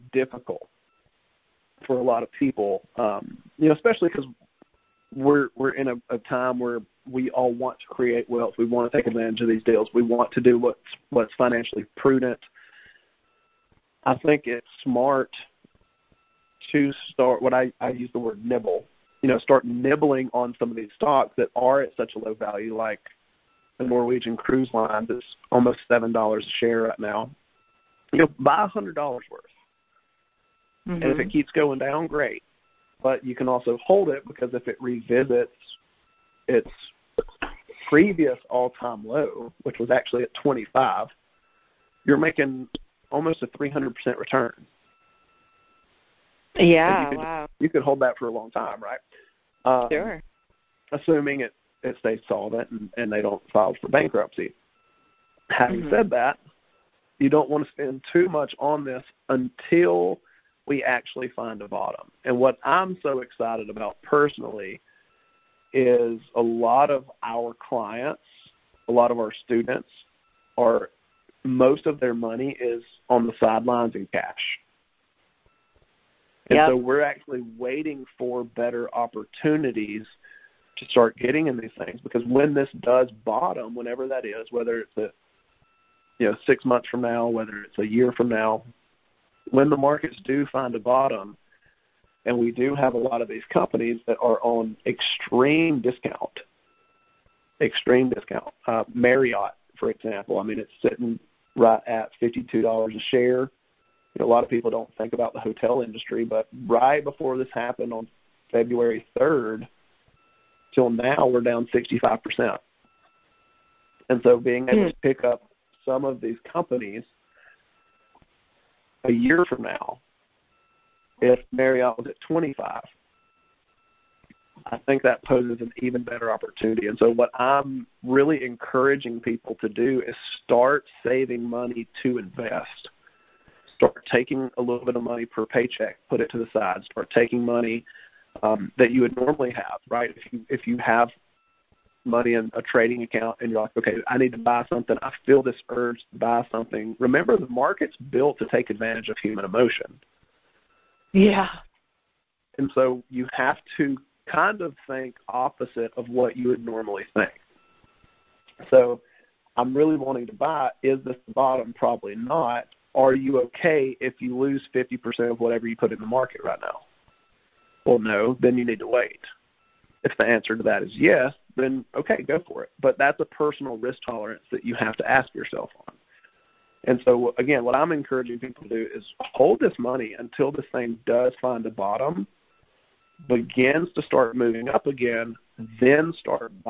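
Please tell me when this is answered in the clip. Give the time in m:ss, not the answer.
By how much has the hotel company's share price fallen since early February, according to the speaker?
1:51.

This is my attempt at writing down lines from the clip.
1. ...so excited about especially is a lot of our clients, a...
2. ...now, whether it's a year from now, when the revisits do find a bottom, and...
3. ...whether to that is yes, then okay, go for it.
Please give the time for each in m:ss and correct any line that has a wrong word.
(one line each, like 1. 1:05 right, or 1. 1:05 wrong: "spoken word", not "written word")
1. 1:03 wrong: "personally", not "especially"
2. 1:27 wrong: "markets", not "revisits"
3. 2:50 wrong: "answer", not "whether".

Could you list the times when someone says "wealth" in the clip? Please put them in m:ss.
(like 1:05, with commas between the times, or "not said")
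0:08.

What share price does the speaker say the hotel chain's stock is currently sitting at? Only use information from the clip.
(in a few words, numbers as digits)
$52.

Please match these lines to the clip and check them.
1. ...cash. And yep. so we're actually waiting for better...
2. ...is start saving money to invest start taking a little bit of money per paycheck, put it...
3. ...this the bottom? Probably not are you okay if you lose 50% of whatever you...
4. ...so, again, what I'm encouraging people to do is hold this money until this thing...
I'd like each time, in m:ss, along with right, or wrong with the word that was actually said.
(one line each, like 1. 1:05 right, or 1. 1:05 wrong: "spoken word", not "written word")
1. 1:14 right
2. 2:10 right
3. 2:41 right
4. 2:57 right.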